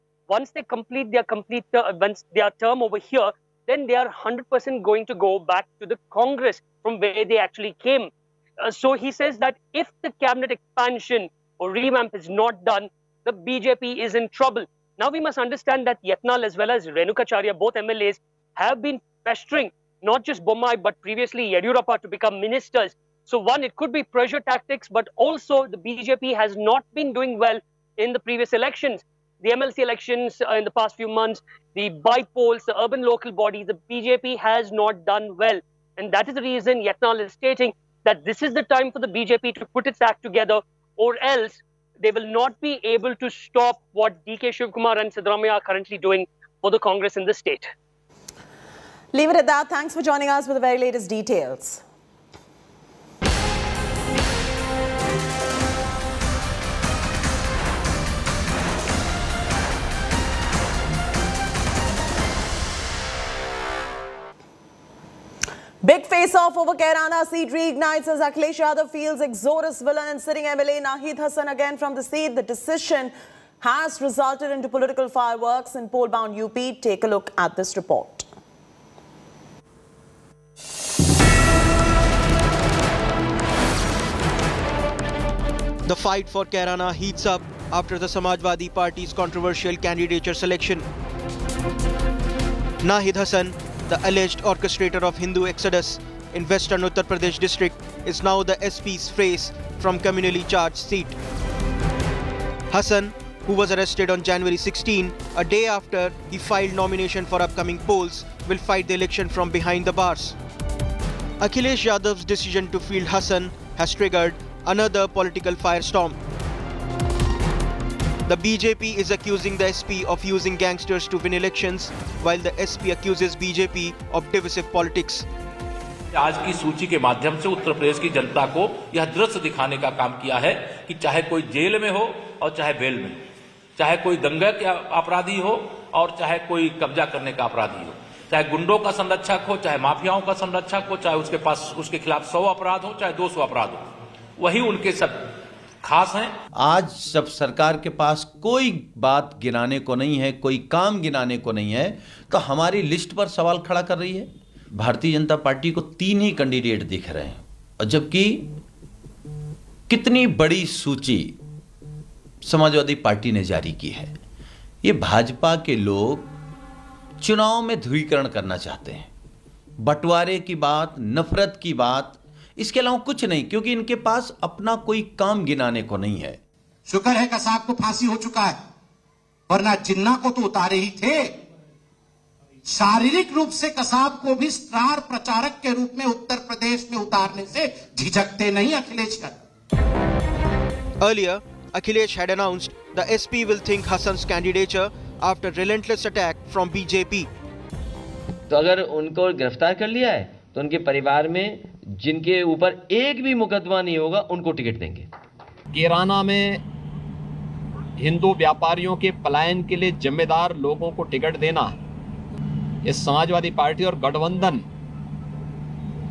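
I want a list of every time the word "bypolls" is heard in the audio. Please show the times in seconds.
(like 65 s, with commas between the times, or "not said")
31 s.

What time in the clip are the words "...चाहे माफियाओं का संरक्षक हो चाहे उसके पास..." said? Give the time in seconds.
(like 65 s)
139 s.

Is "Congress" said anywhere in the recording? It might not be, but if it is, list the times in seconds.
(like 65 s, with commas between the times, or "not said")
6 s, 46 s.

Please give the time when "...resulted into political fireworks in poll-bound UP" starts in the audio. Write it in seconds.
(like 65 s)
73 s.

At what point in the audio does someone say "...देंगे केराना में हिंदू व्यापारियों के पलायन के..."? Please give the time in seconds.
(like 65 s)
204 s.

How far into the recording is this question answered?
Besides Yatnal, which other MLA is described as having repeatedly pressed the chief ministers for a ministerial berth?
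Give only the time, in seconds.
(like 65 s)
16 s.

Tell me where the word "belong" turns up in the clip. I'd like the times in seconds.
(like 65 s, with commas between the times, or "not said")
not said.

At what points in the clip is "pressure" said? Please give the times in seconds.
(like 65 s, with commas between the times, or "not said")
24 s.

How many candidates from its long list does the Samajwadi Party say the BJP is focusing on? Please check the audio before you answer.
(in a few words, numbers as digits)
3.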